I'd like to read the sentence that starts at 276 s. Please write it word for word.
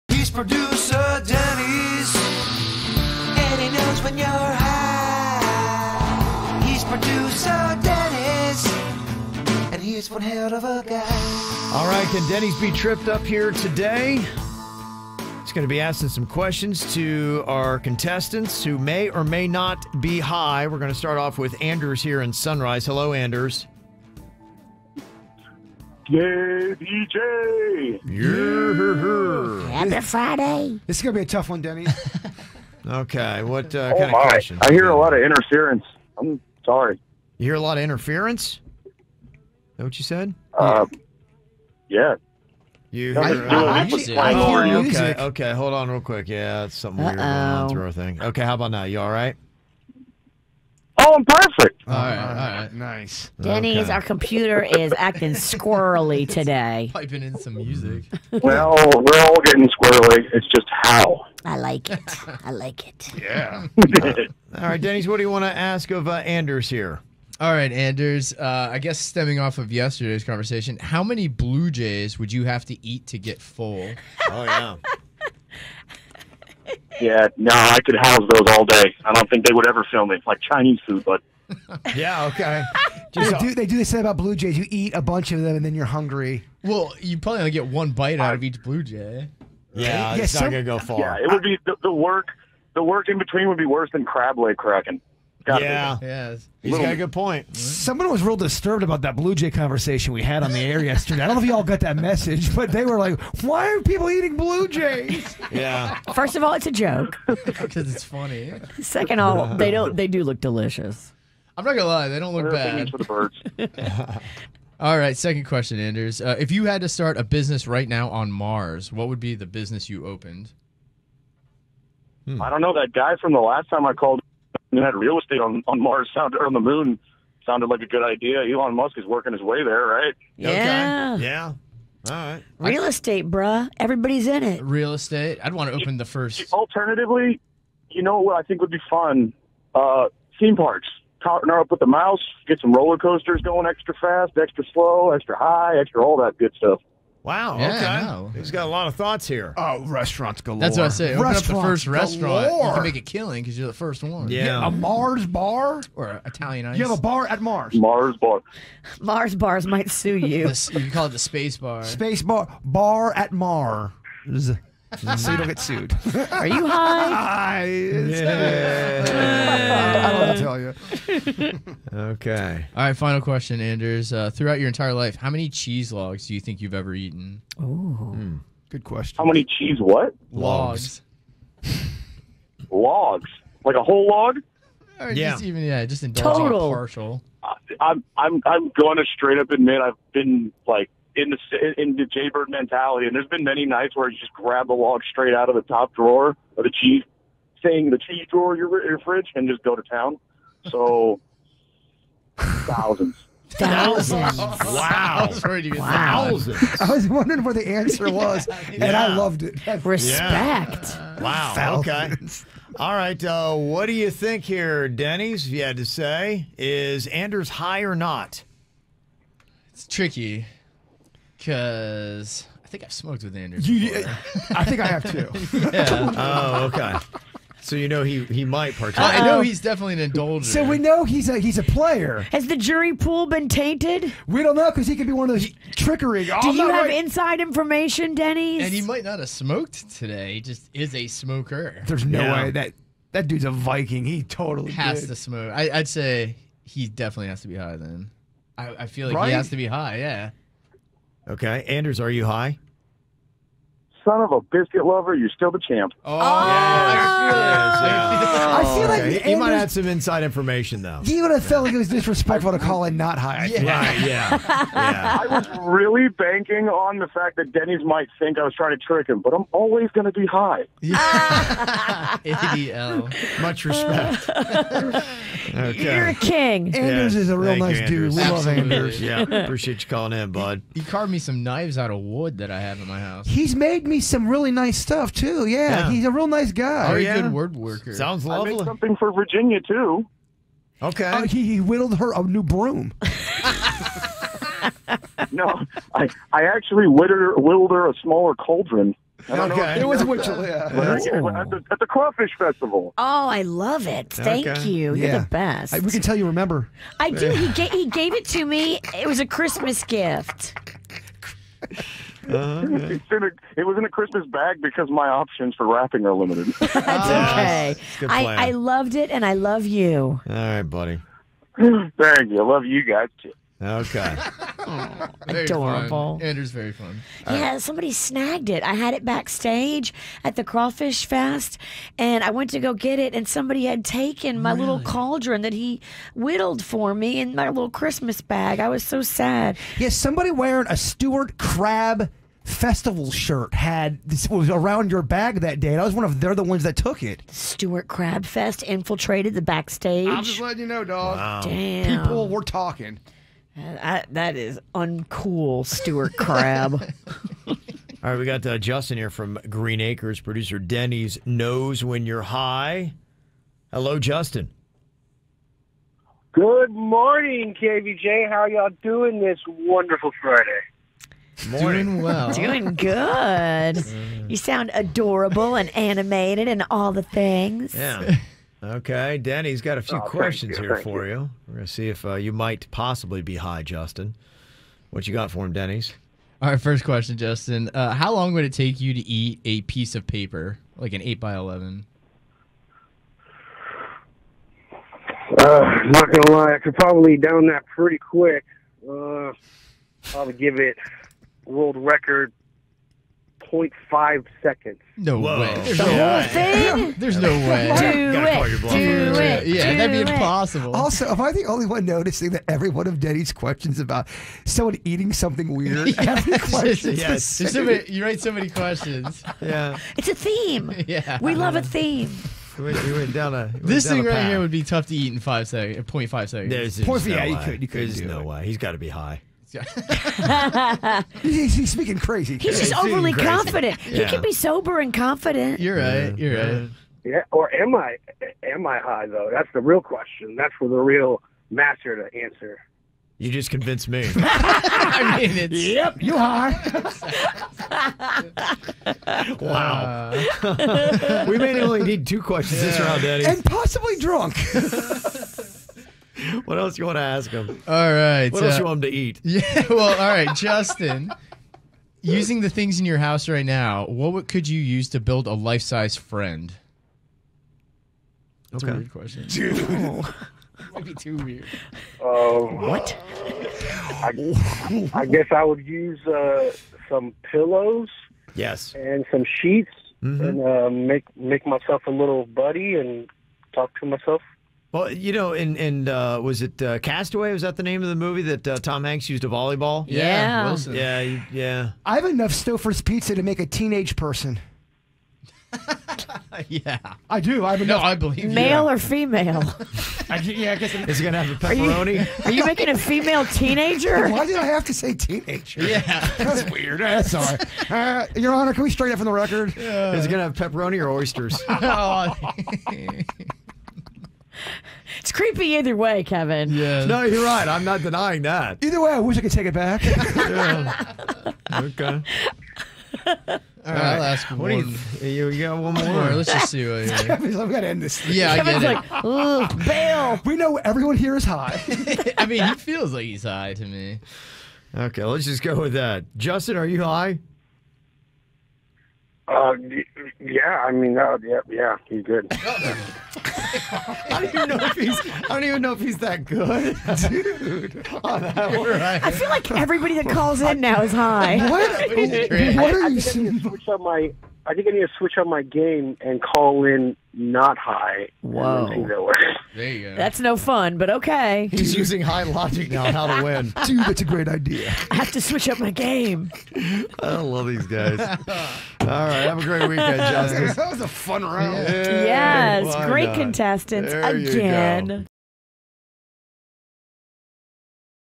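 Andrews is a real Thank you, nice dude.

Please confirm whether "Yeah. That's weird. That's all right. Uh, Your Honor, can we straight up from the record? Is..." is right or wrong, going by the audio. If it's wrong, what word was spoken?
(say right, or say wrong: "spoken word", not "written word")
right.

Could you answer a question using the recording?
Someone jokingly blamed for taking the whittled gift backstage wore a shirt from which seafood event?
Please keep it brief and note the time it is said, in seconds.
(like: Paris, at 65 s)
Stuart Crab Festival, at 340 s.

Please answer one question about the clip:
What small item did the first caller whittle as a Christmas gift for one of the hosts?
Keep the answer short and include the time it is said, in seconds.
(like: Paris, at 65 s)
A smaller cauldron, at 298 s.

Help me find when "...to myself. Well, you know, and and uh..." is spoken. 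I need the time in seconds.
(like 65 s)
483 s.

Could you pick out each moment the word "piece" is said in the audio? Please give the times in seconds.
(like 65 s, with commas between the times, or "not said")
389 s.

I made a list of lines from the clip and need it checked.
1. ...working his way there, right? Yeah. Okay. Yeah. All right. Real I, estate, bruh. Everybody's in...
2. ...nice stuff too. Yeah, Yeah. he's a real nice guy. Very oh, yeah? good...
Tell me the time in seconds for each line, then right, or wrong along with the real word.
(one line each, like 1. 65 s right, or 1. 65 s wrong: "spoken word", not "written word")
1. 129 s right
2. 284 s right.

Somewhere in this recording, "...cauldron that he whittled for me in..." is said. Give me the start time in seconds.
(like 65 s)
334 s.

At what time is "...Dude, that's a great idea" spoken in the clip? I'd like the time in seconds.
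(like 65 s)
563 s.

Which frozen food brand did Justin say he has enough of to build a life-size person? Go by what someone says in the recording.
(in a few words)
Stouffer's pizza.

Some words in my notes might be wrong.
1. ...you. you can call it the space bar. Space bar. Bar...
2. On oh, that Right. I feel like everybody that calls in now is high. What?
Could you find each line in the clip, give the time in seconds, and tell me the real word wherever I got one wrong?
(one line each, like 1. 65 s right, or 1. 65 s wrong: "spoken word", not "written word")
1. 160 s right
2. 548 s right.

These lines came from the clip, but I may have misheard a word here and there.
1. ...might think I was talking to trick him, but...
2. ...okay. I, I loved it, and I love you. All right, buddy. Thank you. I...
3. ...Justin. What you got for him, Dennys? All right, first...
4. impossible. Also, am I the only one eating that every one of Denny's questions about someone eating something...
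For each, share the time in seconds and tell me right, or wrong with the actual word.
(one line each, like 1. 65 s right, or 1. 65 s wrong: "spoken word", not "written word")
1. 267 s wrong: "trying", not "talking"
2. 316 s right
3. 383 s right
4. 410 s wrong: "noticing", not "eating".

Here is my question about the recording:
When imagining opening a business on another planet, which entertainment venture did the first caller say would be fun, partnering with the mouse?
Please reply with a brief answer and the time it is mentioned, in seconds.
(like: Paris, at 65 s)
Theme parks, at 140 s.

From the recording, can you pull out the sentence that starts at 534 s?
Okay, let's just go with that.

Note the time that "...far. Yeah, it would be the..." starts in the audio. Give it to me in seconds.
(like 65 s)
90 s.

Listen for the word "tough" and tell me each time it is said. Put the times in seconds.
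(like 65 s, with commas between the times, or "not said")
31 s, 424 s.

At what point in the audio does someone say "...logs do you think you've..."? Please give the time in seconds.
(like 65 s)
175 s.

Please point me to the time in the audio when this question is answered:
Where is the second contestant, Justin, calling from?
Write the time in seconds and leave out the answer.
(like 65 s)
359 s.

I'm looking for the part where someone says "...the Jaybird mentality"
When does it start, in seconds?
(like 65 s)
191 s.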